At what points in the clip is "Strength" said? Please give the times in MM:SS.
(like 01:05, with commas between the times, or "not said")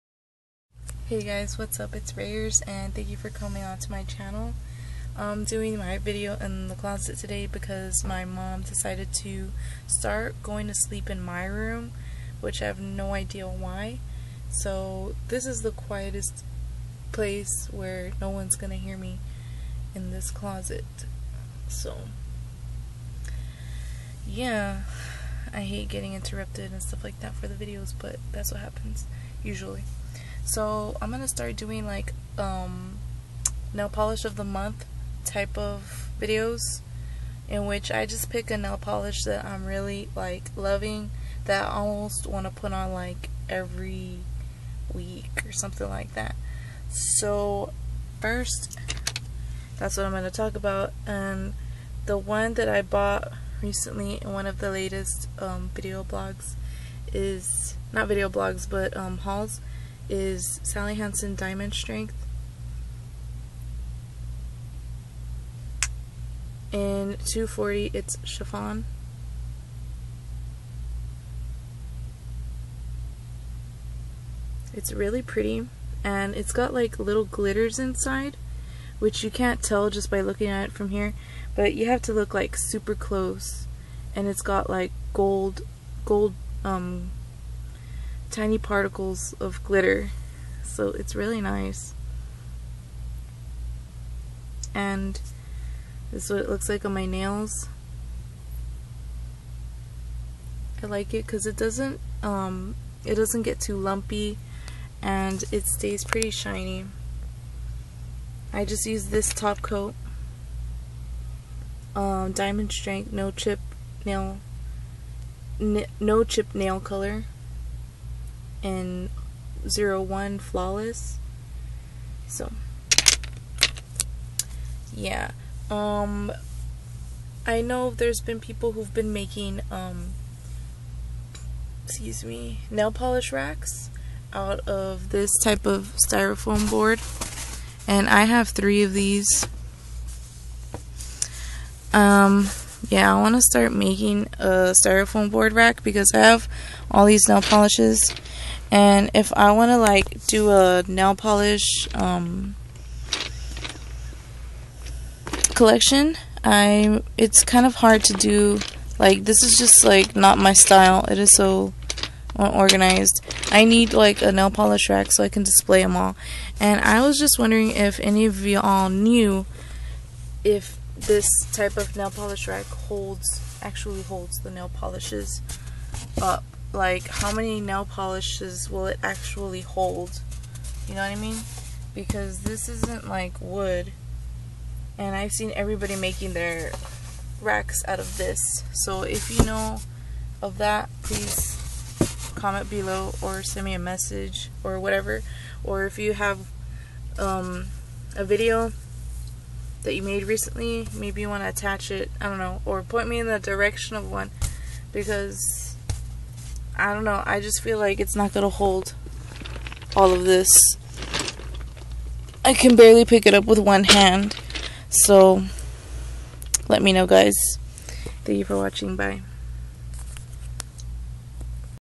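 01:01, 01:52.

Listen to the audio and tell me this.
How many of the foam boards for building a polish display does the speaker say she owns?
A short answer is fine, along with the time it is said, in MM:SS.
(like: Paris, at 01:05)
3, at 02:18.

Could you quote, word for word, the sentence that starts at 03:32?
I can barely pick it up with one hand.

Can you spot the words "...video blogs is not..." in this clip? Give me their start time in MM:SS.
00:55.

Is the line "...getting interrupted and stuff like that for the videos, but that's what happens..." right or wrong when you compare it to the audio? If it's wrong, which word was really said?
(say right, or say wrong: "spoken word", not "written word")
right.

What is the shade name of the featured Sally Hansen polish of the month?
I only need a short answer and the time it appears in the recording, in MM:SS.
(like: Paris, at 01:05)
Chiffon, at 01:08.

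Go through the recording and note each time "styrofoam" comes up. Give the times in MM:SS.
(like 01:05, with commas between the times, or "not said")
02:16, 02:24.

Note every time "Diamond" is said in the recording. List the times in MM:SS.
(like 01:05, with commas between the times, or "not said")
01:01, 01:52.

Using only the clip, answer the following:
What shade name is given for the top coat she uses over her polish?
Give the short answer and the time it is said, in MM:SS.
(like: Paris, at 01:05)
Flawless, at 02:00.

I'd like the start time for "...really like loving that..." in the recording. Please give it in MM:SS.
00:39.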